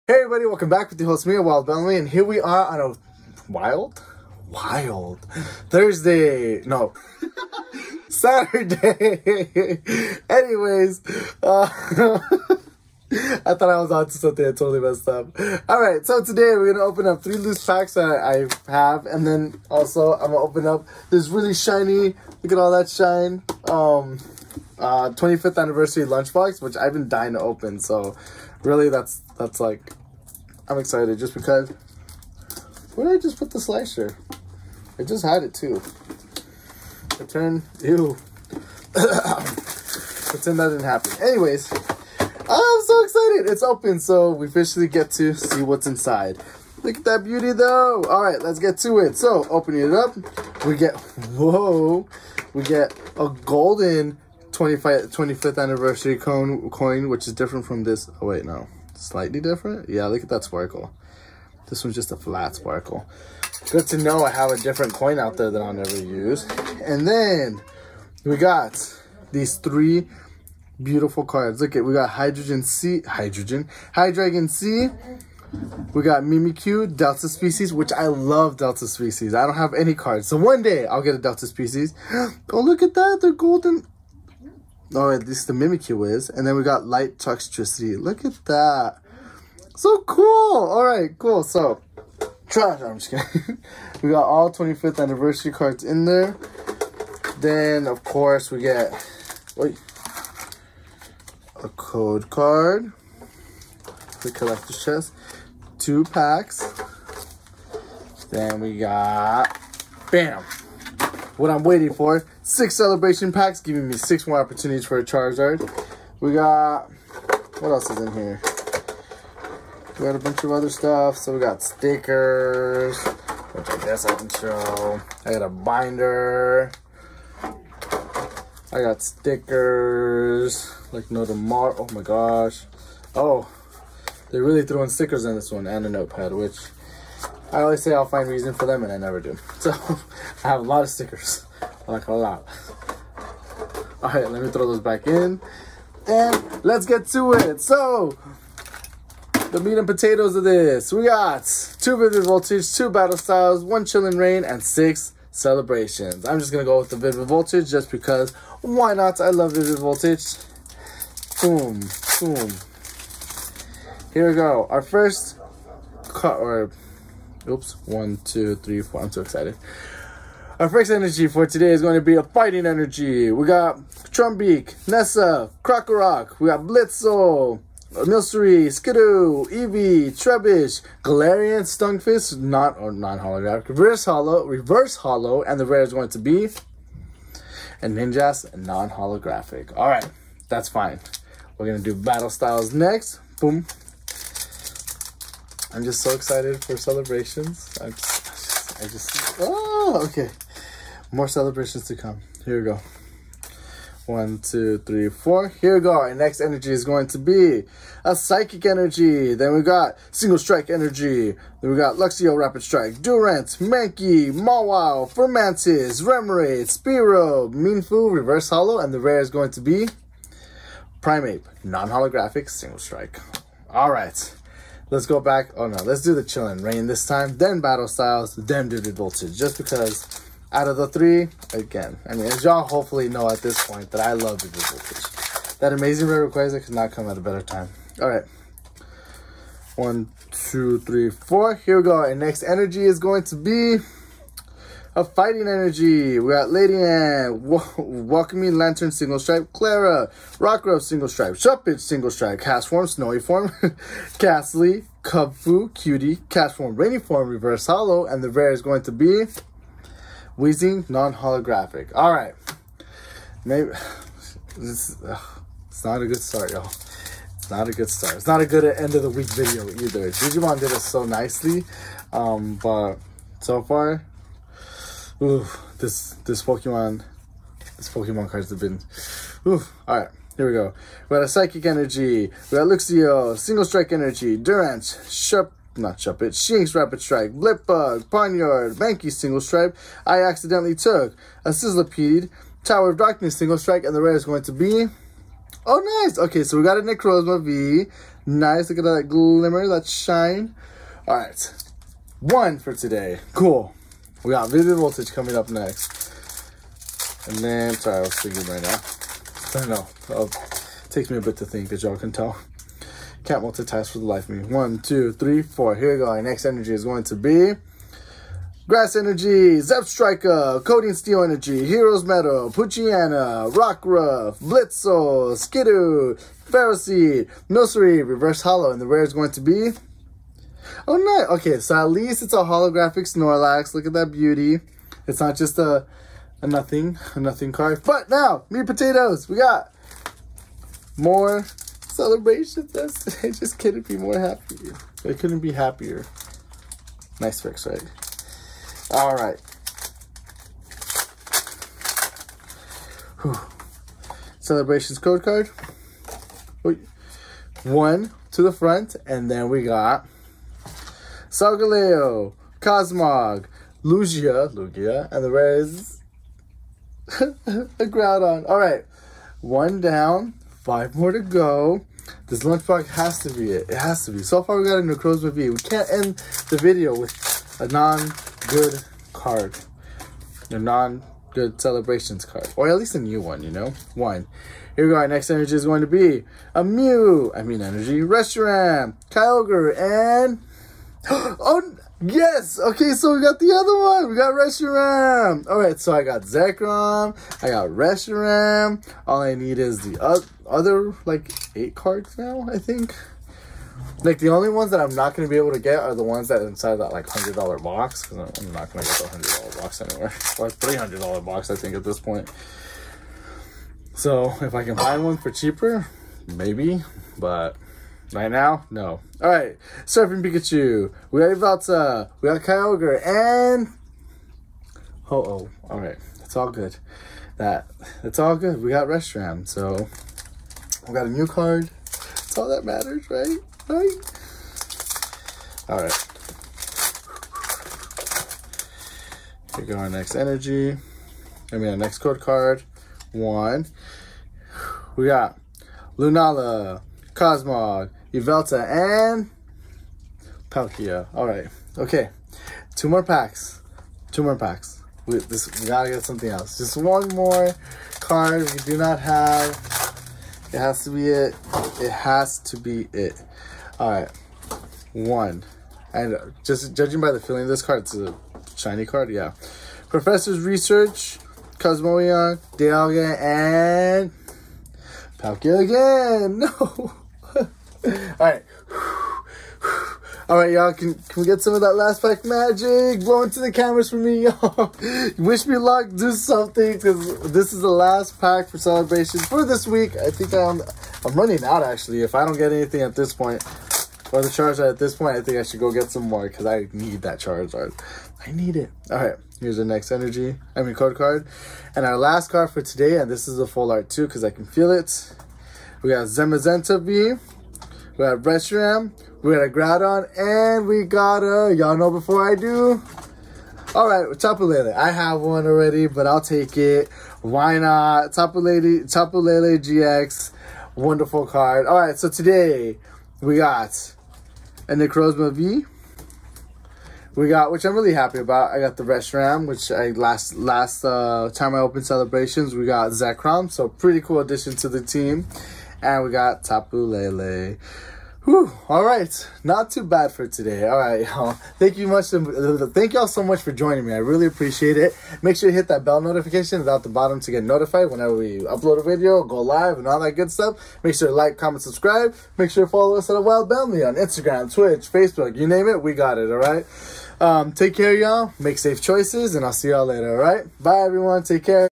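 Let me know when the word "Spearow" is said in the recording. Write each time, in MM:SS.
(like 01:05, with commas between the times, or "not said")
03:36.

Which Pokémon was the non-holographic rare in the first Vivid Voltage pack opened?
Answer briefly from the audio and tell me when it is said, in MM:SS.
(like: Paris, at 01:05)
Ninjask, at 03:07.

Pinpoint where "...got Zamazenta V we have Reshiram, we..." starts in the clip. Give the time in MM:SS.
08:25.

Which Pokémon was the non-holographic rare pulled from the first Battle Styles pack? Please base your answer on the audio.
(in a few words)
Primeape.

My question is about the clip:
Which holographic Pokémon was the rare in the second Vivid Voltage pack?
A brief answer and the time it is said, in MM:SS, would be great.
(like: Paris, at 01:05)
Snorlax, at 05:33.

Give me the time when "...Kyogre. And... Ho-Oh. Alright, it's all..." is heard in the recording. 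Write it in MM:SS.
07:02.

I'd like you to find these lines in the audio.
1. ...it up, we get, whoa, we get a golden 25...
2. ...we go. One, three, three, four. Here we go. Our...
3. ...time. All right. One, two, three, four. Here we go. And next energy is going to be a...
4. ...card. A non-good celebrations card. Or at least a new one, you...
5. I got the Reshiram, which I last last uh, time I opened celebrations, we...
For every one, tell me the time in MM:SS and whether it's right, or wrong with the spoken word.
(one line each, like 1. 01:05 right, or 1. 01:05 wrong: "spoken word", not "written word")
1. 00:49 right
2. 03:22 wrong: "two", not "three"
3. 03:57 right
4. 06:19 right
5. 08:48 right.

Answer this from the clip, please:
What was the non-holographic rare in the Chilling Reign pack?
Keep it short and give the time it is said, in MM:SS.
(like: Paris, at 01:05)
Wheezing, at 04:20.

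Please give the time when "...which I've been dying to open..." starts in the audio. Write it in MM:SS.
00:26.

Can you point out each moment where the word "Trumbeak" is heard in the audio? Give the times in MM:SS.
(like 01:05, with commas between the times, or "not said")
02:54.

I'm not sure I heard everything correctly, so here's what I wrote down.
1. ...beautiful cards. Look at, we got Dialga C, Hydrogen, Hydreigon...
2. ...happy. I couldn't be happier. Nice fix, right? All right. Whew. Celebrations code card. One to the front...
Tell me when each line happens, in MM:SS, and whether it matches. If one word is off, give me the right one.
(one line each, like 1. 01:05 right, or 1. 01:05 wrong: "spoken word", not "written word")
1. 01:10 wrong: "Hydrogen", not "Dialga"
2. 05:44 right.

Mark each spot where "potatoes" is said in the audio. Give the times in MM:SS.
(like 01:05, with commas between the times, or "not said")
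02:29, 05:38.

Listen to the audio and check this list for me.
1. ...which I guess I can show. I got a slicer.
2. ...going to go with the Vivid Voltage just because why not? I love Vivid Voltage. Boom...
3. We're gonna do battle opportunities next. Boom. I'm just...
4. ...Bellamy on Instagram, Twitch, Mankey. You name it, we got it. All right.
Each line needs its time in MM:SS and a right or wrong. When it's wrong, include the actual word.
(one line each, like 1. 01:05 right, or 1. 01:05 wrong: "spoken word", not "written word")
1. 02:03 wrong: "binder", not "slicer"
2. 02:36 right
3. 03:11 wrong: "styles", not "opportunities"
4. 09:13 wrong: "Facebook", not "Mankey".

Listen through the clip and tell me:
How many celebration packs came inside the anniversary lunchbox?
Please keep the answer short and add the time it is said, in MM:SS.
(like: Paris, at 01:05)
6, at 01:52.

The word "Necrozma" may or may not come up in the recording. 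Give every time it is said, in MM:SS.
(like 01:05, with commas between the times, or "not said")
04:56, 06:14, 08:44.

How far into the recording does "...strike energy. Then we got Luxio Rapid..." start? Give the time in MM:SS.
03:30.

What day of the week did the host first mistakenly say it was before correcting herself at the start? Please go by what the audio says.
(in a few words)
Thursday.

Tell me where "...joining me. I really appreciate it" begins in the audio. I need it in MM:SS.
09:03.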